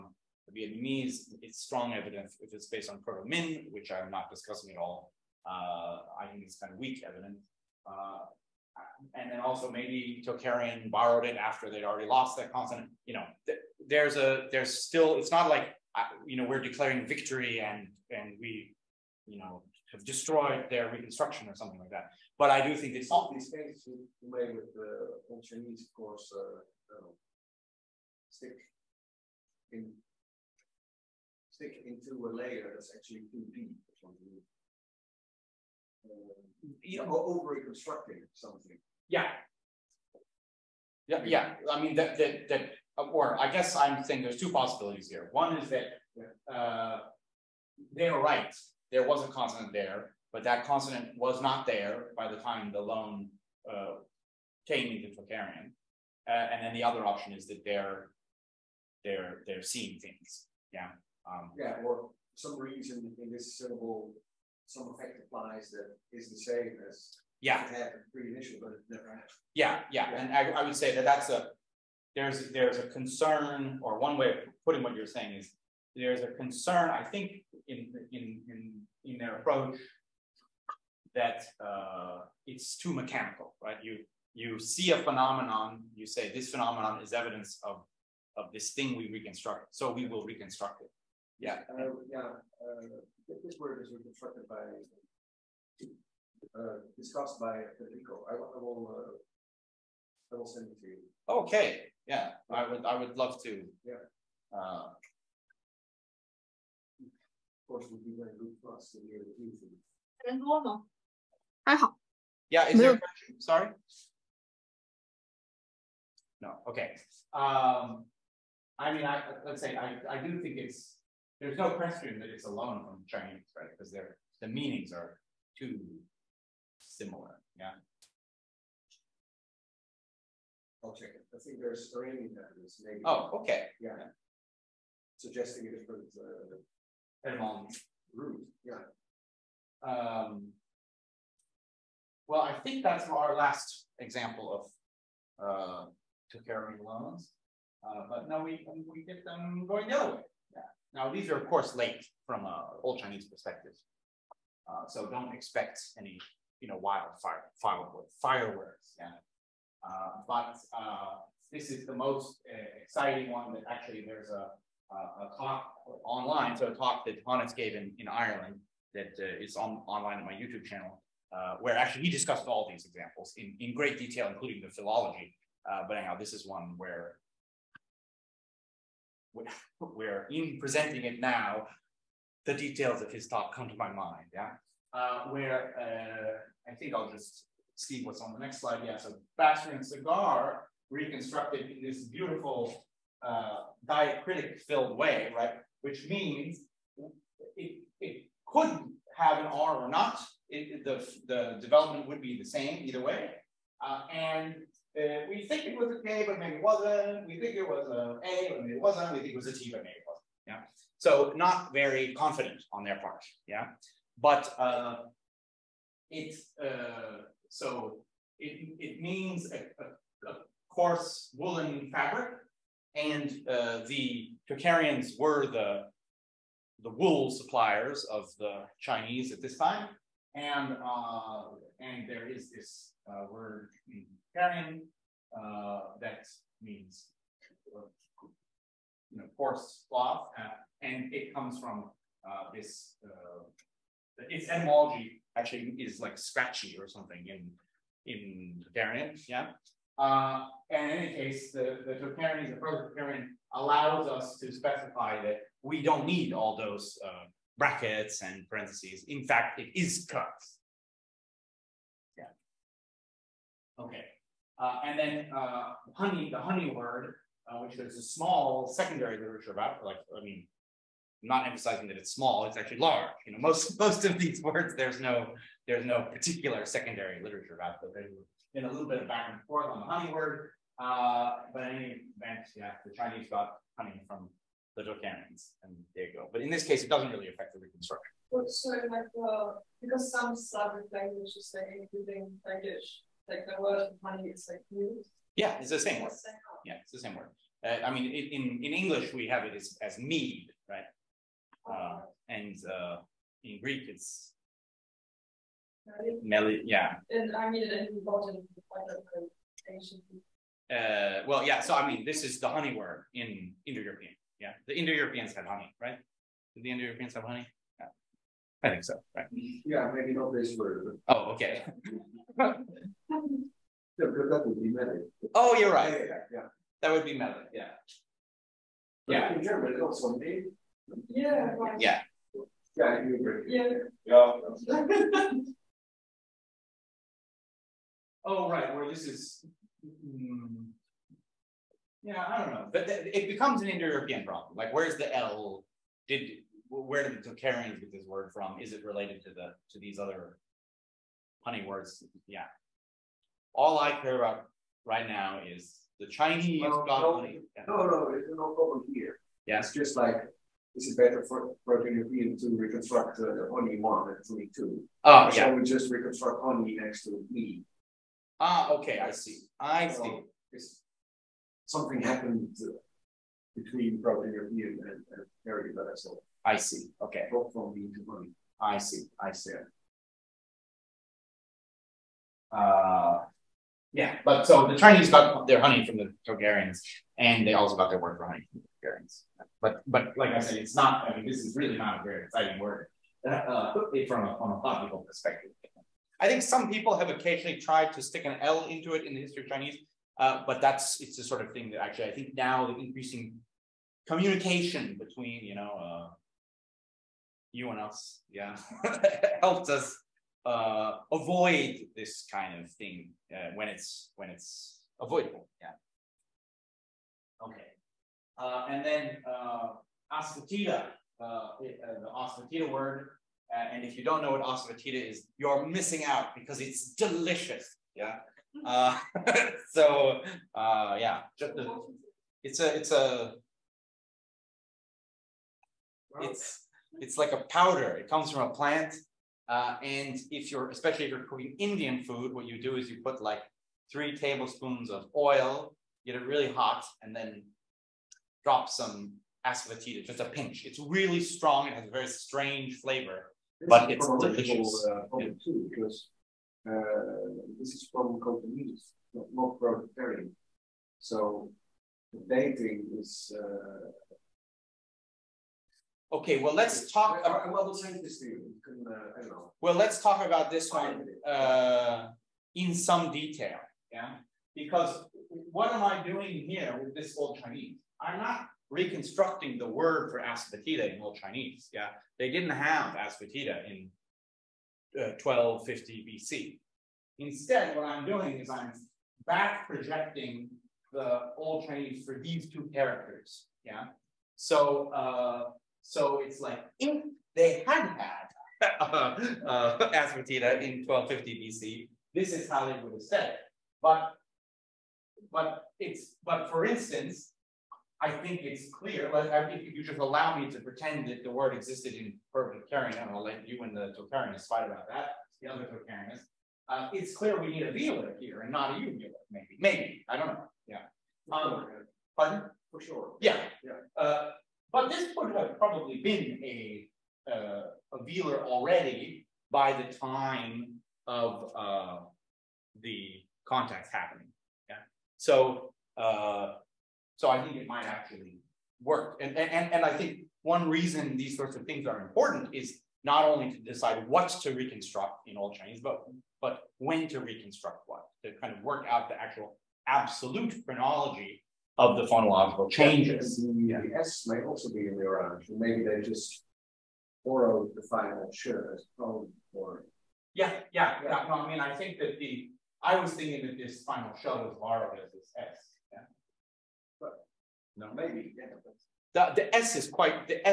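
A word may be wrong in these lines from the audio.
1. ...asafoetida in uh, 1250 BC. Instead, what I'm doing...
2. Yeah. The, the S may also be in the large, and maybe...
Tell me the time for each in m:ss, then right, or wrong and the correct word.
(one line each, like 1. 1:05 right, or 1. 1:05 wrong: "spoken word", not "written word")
1. 8:02 right
2. 9:13 wrong: "orange", not "large".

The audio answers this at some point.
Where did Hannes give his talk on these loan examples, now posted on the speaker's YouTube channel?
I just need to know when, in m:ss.
2:48.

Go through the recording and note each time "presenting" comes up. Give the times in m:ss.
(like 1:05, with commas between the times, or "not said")
3:00.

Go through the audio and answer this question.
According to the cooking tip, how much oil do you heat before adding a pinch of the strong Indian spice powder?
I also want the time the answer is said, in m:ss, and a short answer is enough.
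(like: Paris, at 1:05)
3 tablespoons, at 7:23.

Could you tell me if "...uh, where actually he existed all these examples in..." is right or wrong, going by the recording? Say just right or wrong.
wrong.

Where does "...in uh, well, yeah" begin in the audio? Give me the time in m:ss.
5:07.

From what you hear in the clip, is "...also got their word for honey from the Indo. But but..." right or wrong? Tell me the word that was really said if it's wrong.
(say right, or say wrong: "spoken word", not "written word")
wrong: "Tocharians", not "Indo".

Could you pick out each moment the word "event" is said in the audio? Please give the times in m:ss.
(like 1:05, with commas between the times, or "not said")
4:42.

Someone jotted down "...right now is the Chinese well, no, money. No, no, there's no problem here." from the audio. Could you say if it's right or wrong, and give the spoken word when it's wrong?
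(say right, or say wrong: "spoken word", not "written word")
right.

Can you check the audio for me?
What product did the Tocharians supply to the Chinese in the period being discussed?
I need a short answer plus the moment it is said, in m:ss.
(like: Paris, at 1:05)
wool, at 3:46.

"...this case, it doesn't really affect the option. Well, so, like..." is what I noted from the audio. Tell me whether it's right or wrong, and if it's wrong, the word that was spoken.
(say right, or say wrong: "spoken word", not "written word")
wrong: "reconstruction", not "option".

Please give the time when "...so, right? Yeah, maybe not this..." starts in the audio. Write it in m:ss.
5:18.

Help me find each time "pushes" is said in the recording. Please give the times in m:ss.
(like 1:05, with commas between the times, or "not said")
not said.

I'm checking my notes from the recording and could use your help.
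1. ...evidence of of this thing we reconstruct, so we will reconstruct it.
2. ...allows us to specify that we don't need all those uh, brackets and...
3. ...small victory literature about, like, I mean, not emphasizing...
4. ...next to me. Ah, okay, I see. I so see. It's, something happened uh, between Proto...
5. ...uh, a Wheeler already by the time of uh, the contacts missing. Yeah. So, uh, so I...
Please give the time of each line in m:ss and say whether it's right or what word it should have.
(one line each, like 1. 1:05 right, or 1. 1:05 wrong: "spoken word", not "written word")
1. 1:27 right
2. 4:13 right
3. 4:28 wrong: "secondary", not "victory"
4. 6:06 right
5. 8:47 wrong: "happening", not "missing".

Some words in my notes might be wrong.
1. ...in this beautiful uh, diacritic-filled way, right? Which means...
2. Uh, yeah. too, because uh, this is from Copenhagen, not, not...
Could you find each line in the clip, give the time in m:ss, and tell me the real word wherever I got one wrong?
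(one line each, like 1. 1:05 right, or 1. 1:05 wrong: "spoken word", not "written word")
1. 3:11 right
2. 7:34 right.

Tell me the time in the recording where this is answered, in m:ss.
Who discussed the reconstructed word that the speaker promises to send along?
1:37.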